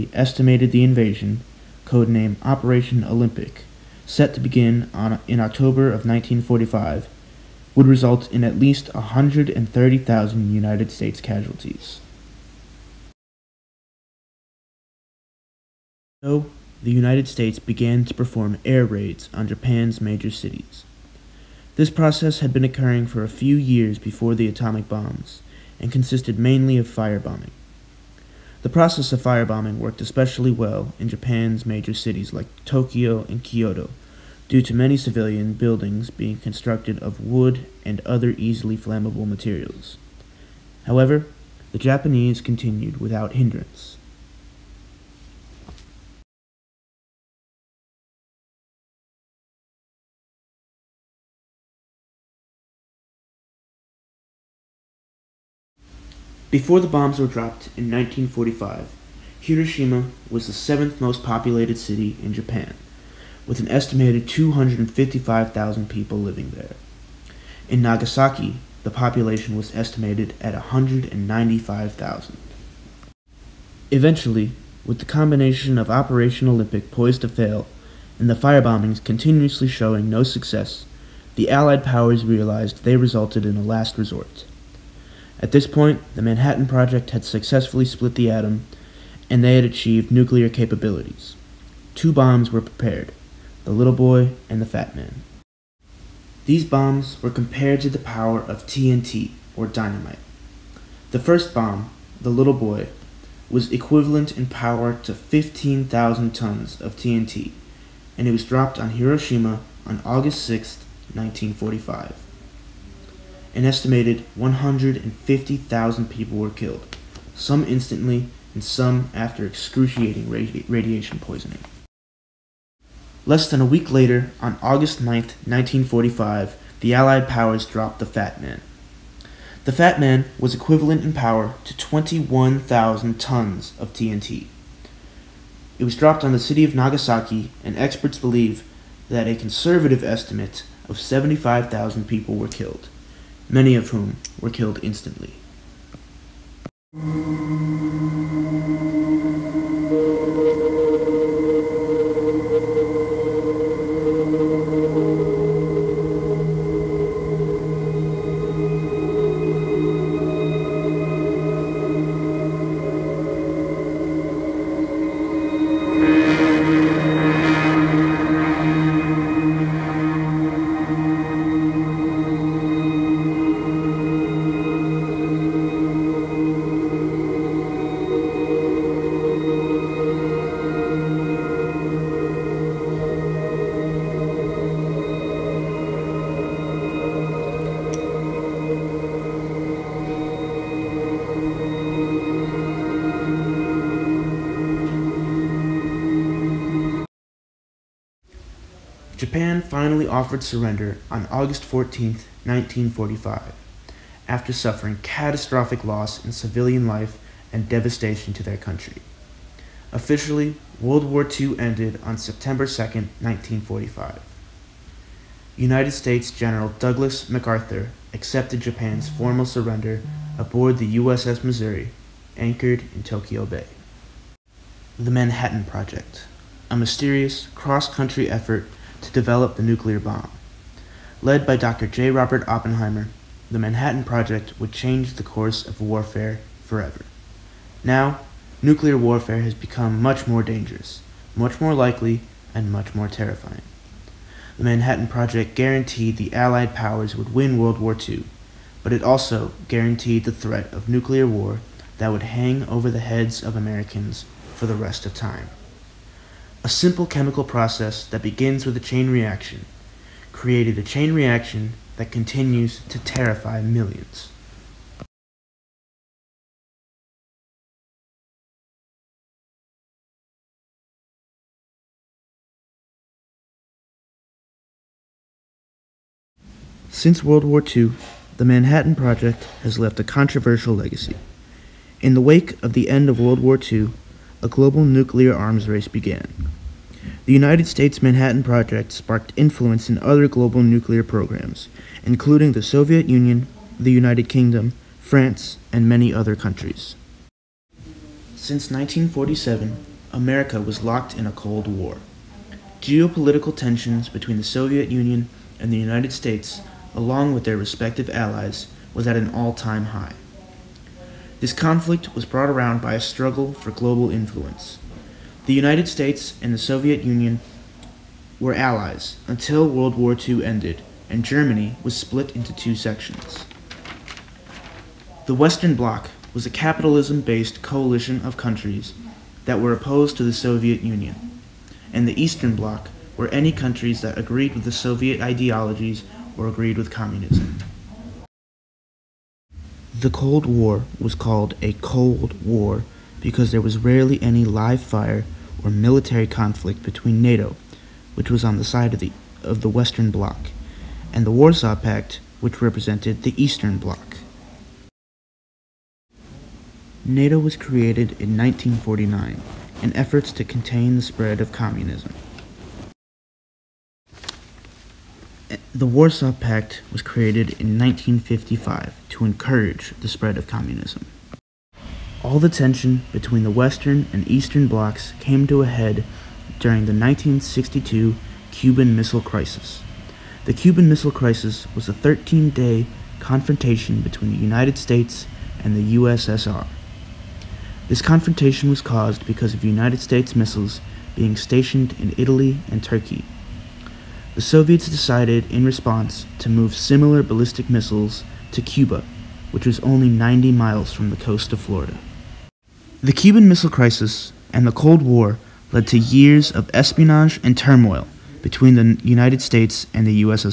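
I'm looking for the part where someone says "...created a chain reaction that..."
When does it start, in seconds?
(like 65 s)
260 s.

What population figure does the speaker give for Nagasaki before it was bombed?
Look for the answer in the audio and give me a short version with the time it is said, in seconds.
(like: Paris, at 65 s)
195,000, at 70 s.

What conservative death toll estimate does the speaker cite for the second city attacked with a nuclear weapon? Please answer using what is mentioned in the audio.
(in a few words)
75,000.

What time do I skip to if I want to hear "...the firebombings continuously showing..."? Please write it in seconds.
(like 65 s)
78 s.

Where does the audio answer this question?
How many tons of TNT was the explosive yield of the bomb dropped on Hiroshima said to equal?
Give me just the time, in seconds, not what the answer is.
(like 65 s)
105 s.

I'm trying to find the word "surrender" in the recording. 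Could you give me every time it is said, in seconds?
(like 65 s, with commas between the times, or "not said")
200 s, 219 s.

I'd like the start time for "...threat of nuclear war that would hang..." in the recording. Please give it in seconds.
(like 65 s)
250 s.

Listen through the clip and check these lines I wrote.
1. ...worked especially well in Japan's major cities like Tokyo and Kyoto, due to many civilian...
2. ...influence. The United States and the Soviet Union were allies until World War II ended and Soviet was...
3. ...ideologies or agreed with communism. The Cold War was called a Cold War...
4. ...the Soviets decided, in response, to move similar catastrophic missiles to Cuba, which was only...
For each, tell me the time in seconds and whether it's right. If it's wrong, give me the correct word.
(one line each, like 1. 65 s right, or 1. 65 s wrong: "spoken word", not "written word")
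1. 29 s right
2. 314 s wrong: "Germany", not "Soviet"
3. 335 s right
4. 394 s wrong: "ballistic", not "catastrophic".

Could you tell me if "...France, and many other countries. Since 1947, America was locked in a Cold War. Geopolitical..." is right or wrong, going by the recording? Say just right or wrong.
right.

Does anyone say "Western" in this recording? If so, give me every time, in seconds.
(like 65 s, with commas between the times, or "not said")
325 s, 349 s, 373 s.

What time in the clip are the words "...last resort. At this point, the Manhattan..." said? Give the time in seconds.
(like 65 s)
83 s.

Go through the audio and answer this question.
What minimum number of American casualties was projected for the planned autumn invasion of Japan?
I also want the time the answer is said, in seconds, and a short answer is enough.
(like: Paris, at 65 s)
130,000, at 8 s.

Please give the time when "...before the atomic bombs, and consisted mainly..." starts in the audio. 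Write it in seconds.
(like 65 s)
23 s.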